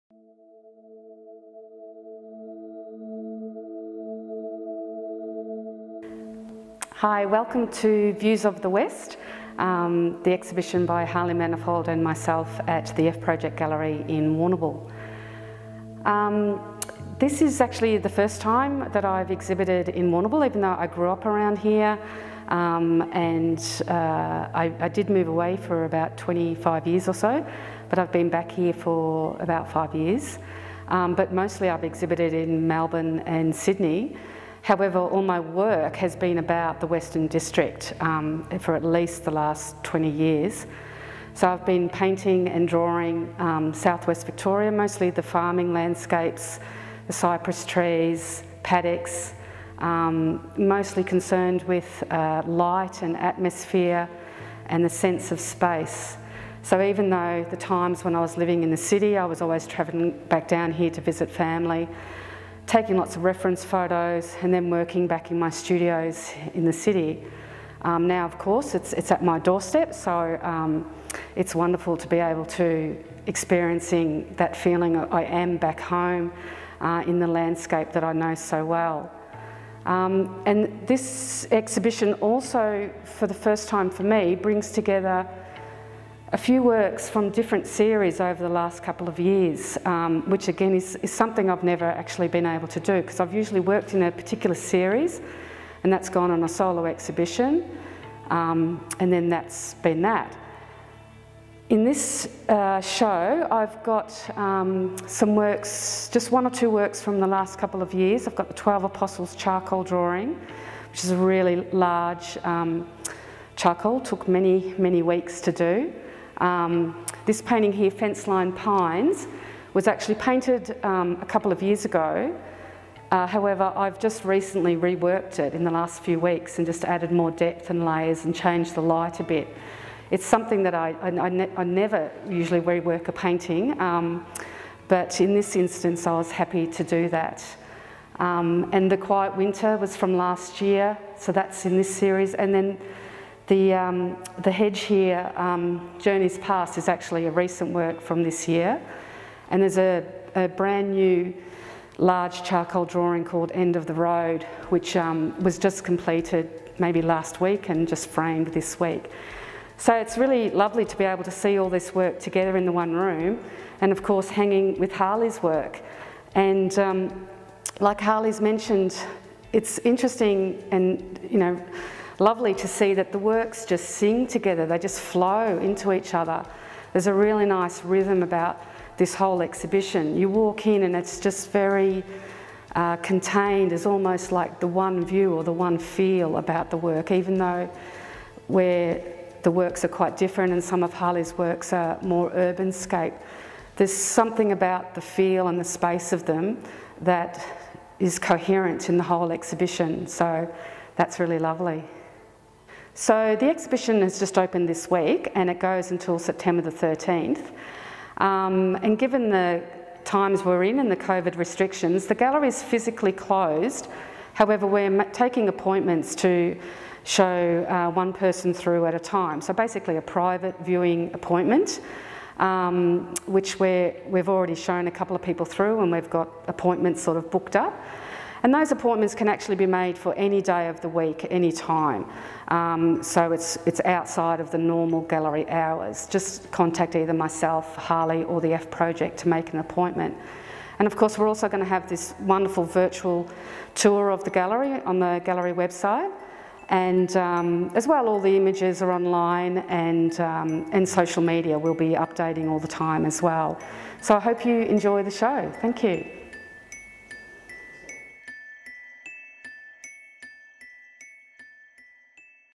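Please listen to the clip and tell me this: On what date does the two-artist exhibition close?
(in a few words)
September 13.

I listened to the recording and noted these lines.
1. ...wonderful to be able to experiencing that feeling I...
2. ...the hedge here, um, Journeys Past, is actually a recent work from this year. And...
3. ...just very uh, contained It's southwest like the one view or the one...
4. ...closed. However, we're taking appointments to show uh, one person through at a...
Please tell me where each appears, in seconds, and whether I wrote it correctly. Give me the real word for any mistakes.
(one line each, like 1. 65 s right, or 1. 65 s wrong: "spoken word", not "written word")
1. 71 s right
2. 144 s right
3. 181 s wrong: "almost", not "southwest"
4. 213 s right.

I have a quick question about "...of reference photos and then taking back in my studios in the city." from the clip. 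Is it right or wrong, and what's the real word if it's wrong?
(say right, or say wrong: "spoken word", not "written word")
wrong: "working", not "taking".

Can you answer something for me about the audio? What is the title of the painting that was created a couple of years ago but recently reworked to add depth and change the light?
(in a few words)
Fence Line Pines.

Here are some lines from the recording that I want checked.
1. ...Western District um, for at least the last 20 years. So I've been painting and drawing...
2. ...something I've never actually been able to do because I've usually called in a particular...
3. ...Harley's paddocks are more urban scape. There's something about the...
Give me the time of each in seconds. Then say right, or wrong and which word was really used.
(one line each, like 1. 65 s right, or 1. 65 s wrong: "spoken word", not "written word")
1. 36 s right
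2. 91 s wrong: "worked", not "called"
3. 190 s wrong: "works", not "paddocks".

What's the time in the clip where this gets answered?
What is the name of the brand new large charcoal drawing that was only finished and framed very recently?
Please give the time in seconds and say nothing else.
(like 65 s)
153 s.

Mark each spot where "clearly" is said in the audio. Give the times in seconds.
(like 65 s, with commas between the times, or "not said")
not said.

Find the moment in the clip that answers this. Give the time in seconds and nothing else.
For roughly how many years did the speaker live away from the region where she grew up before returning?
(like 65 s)
26 s.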